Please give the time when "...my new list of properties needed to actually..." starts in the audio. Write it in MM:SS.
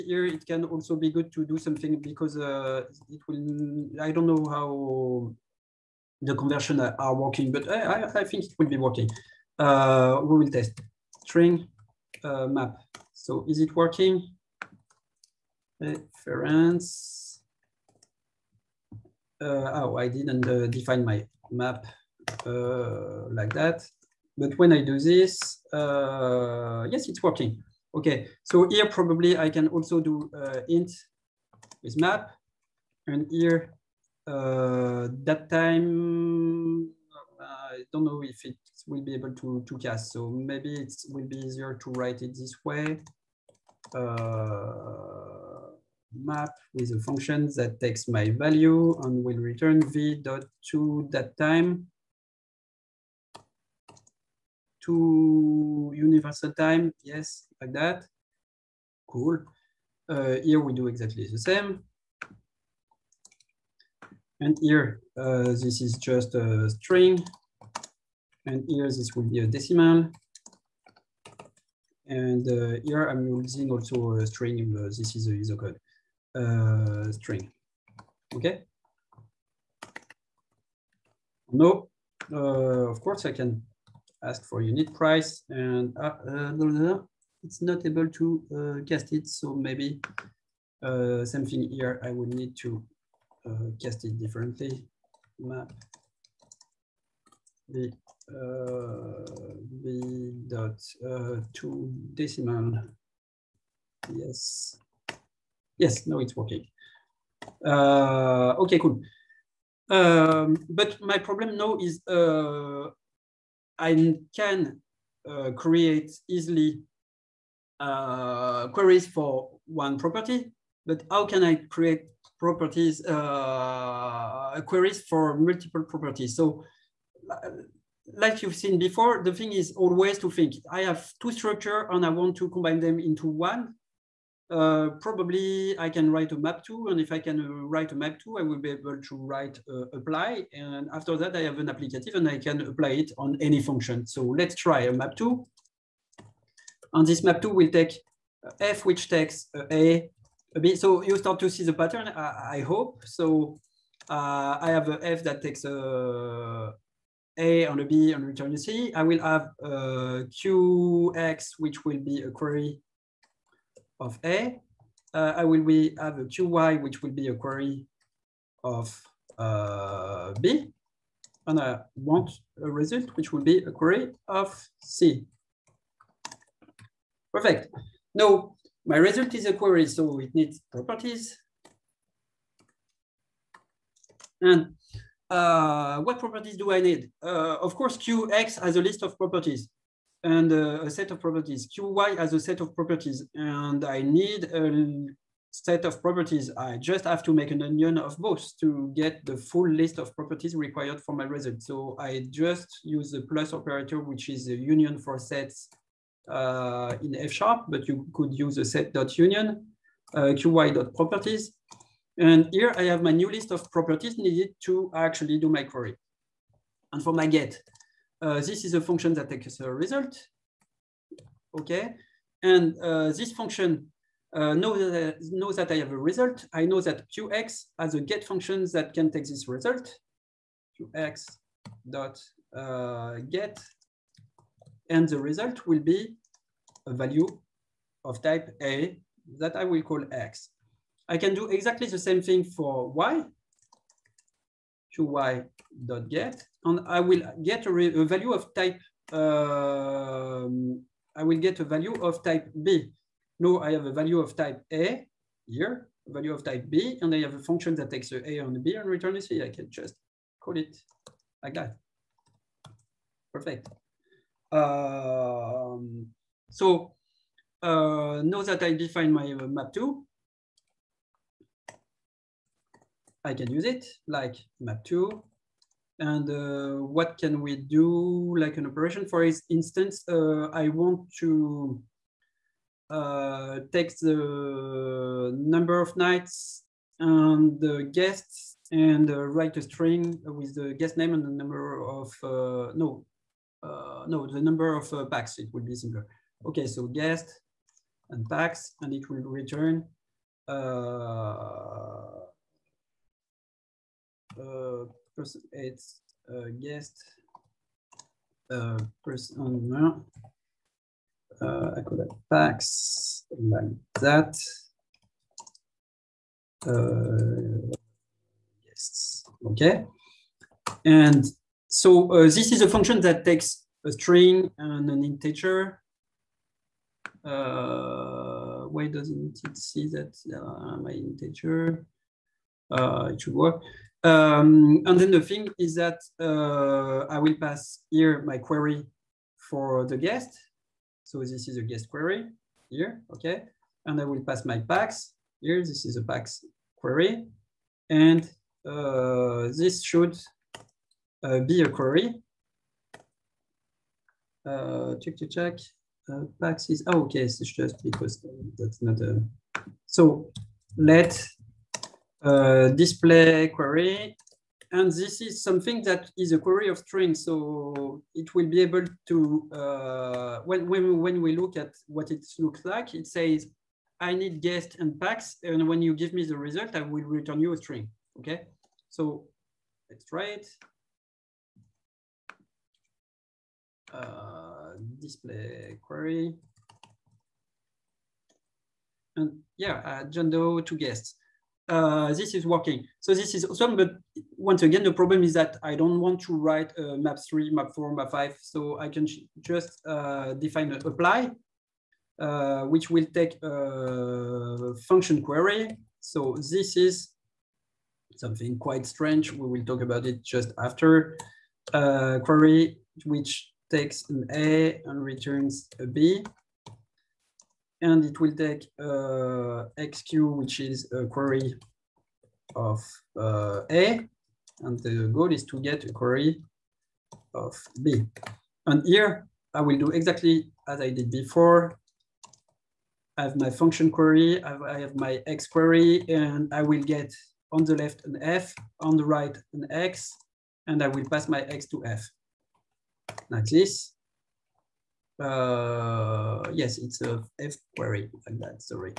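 03:33.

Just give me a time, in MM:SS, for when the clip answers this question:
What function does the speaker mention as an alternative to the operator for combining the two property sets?
03:28.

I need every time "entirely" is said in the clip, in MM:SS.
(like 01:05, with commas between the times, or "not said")
not said.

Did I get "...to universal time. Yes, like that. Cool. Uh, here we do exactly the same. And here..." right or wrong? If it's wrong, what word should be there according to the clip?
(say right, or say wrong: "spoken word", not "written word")
right.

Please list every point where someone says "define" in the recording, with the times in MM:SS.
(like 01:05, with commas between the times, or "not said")
00:20, 04:28, 06:40.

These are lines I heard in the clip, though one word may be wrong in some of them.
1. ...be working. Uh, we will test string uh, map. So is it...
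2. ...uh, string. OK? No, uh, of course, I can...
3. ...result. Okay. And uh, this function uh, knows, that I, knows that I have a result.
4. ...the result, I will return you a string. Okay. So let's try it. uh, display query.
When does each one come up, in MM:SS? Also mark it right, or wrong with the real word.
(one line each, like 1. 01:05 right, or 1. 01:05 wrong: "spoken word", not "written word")
1. 00:08 right
2. 01:16 right
3. 03:39 right
4. 06:16 right.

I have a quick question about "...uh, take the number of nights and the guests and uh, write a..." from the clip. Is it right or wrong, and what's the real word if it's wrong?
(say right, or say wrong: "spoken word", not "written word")
right.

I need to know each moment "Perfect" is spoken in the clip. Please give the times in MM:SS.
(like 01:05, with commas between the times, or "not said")
02:57, 04:23.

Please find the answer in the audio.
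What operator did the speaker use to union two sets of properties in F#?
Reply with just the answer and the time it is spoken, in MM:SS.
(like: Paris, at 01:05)
plus operator, at 03:23.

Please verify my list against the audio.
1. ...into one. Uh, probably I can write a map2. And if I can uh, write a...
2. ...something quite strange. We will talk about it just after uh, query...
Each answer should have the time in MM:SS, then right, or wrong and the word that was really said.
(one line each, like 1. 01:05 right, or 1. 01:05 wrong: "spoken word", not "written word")
1. 02:12 right
2. 06:48 right.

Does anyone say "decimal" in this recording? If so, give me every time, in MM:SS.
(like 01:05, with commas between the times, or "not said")
01:09, 01:42.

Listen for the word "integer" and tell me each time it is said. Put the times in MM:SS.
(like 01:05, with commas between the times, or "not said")
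05:25, 05:30.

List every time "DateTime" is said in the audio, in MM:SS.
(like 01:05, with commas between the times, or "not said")
00:35, 00:51.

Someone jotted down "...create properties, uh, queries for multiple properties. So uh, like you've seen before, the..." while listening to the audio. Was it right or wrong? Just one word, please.
right.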